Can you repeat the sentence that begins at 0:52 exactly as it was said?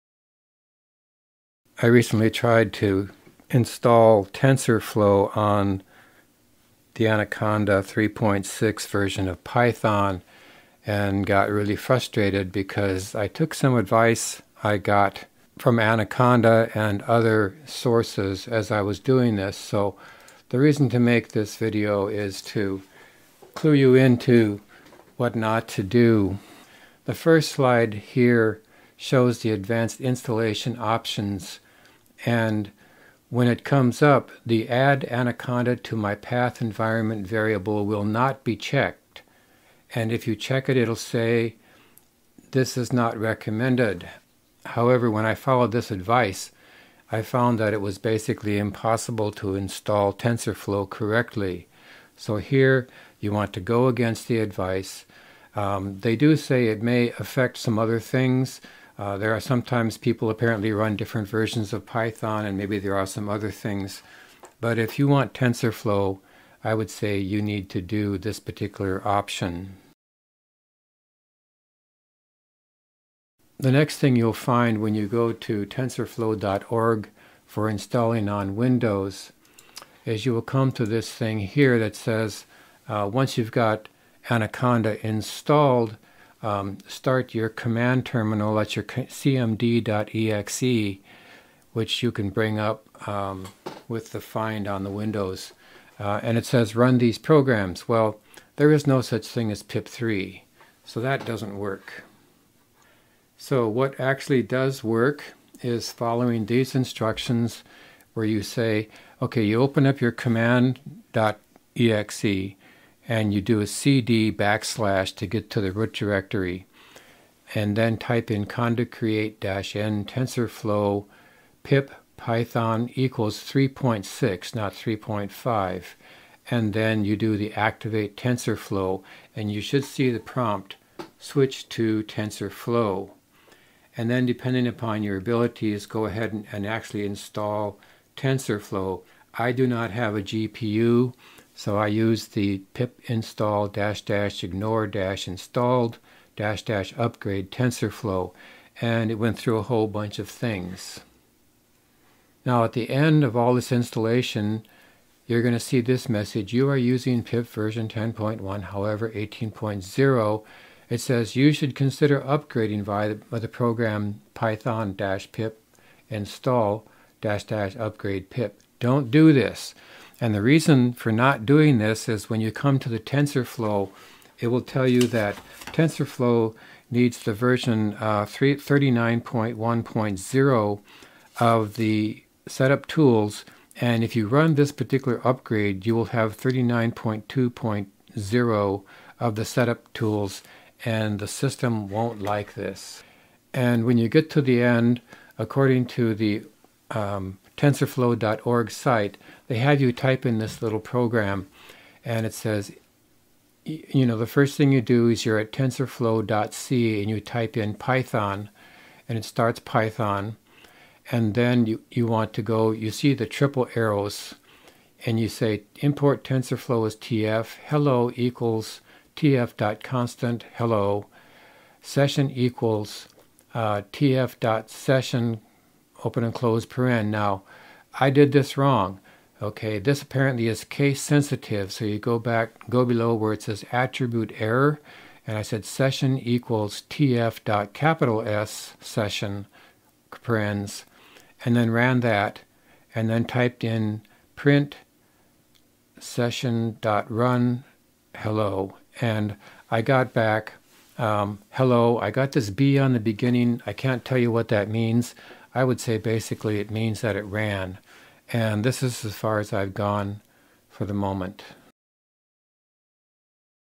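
So here you want to go against the advice.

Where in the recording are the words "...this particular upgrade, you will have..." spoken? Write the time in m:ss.
3:04.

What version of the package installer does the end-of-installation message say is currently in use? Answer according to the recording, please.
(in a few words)
10.1.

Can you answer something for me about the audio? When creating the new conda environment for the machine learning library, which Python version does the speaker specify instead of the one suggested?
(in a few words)
3.6.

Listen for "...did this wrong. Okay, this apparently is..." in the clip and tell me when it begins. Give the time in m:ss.
3:48.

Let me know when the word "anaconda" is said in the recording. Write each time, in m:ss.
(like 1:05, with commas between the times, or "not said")
0:07, 0:15, 0:35, 1:24.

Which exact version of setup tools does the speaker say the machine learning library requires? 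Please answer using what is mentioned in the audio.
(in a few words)
39.1.0.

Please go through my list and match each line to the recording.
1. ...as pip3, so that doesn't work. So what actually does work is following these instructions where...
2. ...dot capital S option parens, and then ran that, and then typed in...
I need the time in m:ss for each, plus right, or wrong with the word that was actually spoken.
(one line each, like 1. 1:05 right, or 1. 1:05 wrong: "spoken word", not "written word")
1. 1:39 right
2. 3:57 wrong: "session", not "option".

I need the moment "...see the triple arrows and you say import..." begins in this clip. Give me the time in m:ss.
3:32.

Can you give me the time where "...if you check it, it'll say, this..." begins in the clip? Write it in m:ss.
0:40.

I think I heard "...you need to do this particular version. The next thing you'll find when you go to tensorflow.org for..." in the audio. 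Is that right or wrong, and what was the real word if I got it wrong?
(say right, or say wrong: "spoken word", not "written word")
wrong: "option", not "version".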